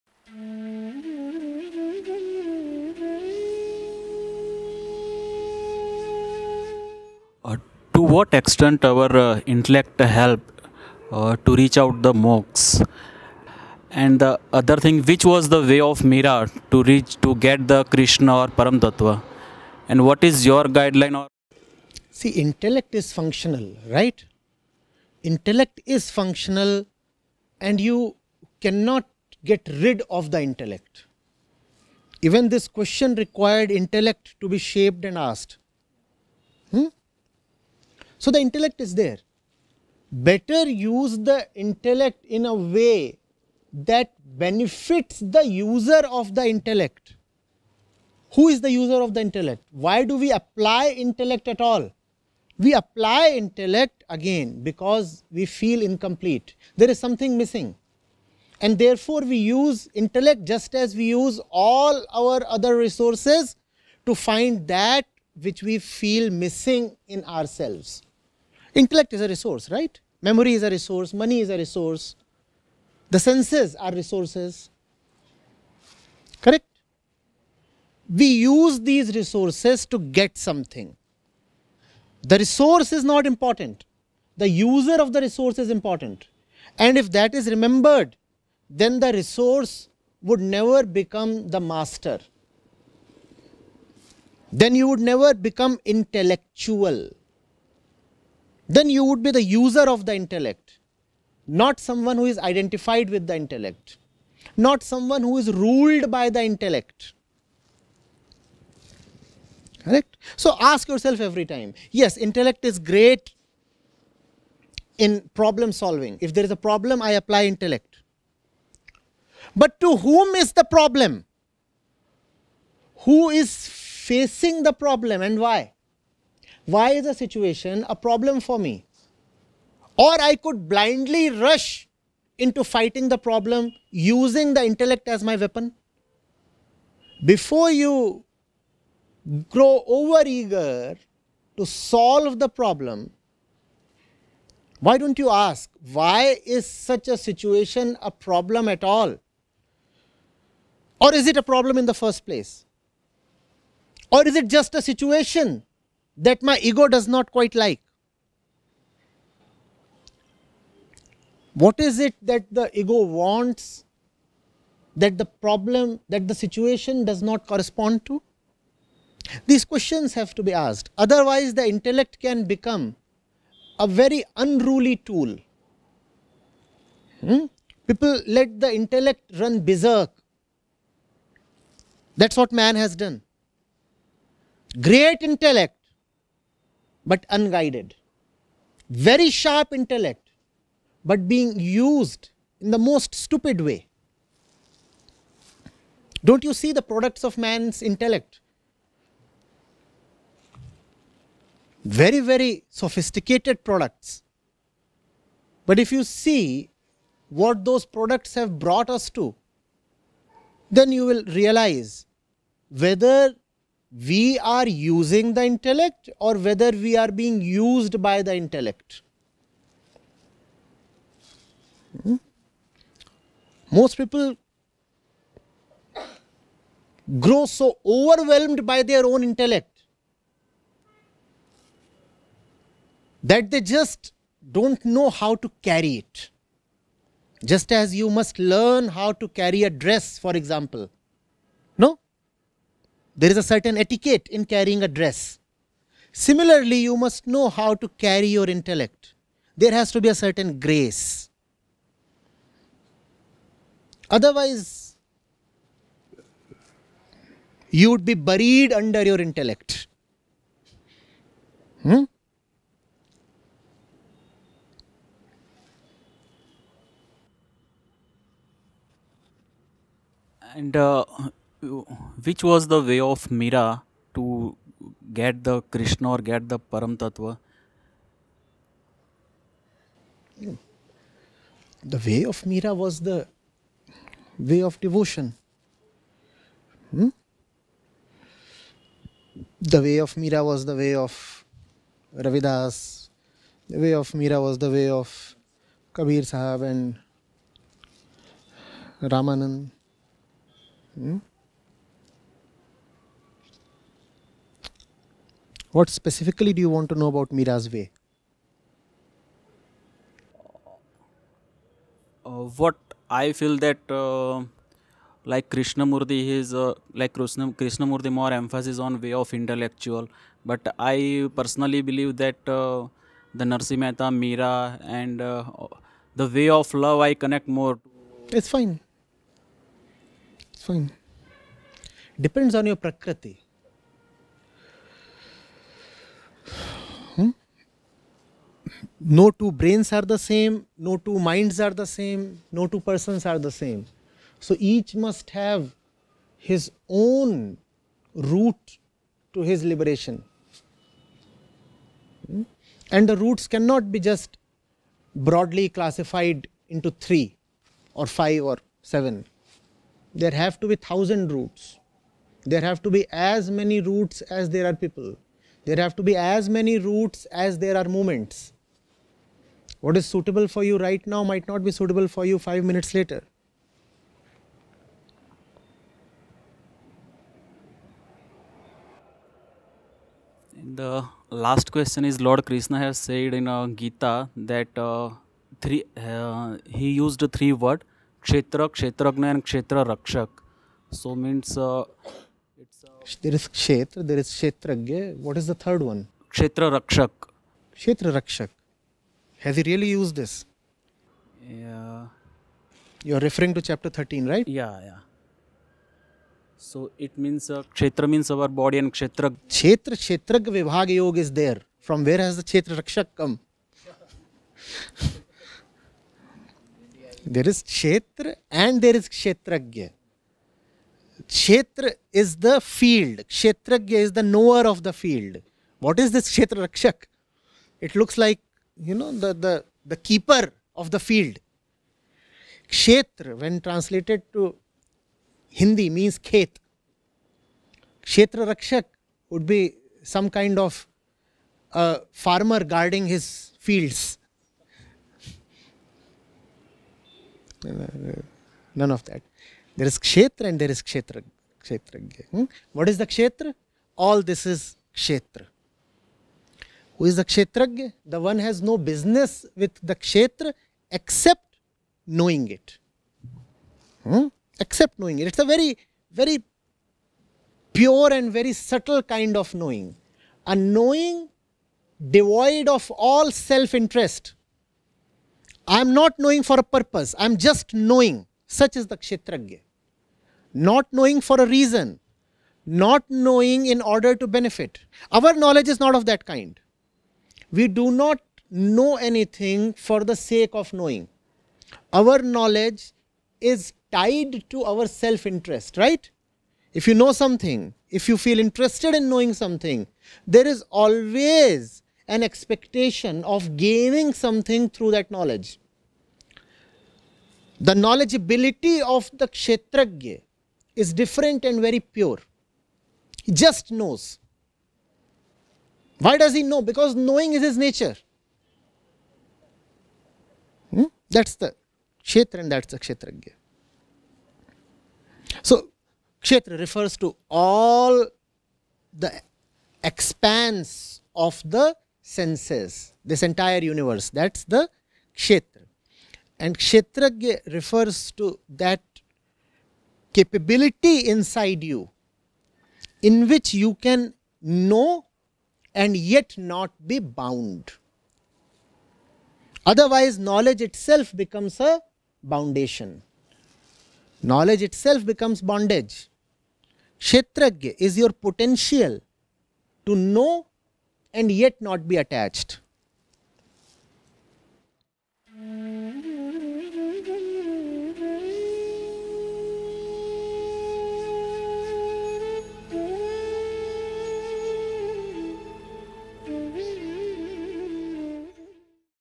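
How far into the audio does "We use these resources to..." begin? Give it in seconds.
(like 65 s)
78 s.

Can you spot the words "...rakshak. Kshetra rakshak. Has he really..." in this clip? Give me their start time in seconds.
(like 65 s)
396 s.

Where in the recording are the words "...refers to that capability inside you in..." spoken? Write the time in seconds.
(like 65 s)
537 s.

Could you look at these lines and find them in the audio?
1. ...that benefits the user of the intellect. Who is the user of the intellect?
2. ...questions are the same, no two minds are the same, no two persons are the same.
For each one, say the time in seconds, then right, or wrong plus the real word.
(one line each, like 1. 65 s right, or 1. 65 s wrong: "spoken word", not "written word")
1. 43 s right
2. 339 s wrong: "brains", not "questions".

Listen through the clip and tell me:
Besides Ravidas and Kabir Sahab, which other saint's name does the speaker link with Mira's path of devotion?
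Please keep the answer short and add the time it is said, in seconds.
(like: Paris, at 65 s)
Ramanand, at 299 s.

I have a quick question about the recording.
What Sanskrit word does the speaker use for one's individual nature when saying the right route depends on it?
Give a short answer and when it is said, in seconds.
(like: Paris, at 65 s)
Prakriti, at 332 s.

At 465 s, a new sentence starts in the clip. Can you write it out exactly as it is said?
It's a very, very pure and very subtle kind of knowing.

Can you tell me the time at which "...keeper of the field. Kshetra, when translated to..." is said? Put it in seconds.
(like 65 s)
429 s.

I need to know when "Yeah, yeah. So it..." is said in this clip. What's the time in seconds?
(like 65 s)
404 s.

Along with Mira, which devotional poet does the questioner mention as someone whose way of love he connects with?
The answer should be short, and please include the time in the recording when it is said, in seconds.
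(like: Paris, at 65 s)
Narsi Mehta, at 323 s.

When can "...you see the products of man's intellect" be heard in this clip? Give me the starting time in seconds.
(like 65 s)
196 s.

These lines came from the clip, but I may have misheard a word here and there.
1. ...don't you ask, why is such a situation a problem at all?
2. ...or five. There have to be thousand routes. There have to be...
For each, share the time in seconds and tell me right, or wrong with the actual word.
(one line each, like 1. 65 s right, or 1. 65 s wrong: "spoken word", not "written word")
1. 144 s right
2. 358 s wrong: "seven", not "five".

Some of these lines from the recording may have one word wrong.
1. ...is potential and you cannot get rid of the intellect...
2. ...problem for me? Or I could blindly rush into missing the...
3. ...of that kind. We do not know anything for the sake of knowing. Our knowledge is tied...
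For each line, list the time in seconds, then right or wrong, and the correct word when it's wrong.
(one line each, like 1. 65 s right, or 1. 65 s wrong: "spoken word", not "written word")
1. 25 s wrong: "functional", not "potential"
2. 127 s wrong: "fighting", not "missing"
3. 485 s right.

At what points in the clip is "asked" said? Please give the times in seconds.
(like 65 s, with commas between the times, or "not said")
35 s, 170 s.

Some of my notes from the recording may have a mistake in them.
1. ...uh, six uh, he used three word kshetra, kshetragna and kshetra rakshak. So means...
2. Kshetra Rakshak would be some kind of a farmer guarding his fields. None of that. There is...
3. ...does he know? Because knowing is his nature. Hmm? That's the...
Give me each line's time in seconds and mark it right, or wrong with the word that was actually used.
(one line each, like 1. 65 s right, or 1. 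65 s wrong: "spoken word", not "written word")
1. 384 s wrong: "three", not "six"
2. 438 s right
3. 516 s right.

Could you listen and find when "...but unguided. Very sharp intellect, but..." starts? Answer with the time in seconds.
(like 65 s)
187 s.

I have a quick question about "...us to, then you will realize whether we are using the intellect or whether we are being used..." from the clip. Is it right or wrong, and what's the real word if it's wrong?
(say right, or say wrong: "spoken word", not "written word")
right.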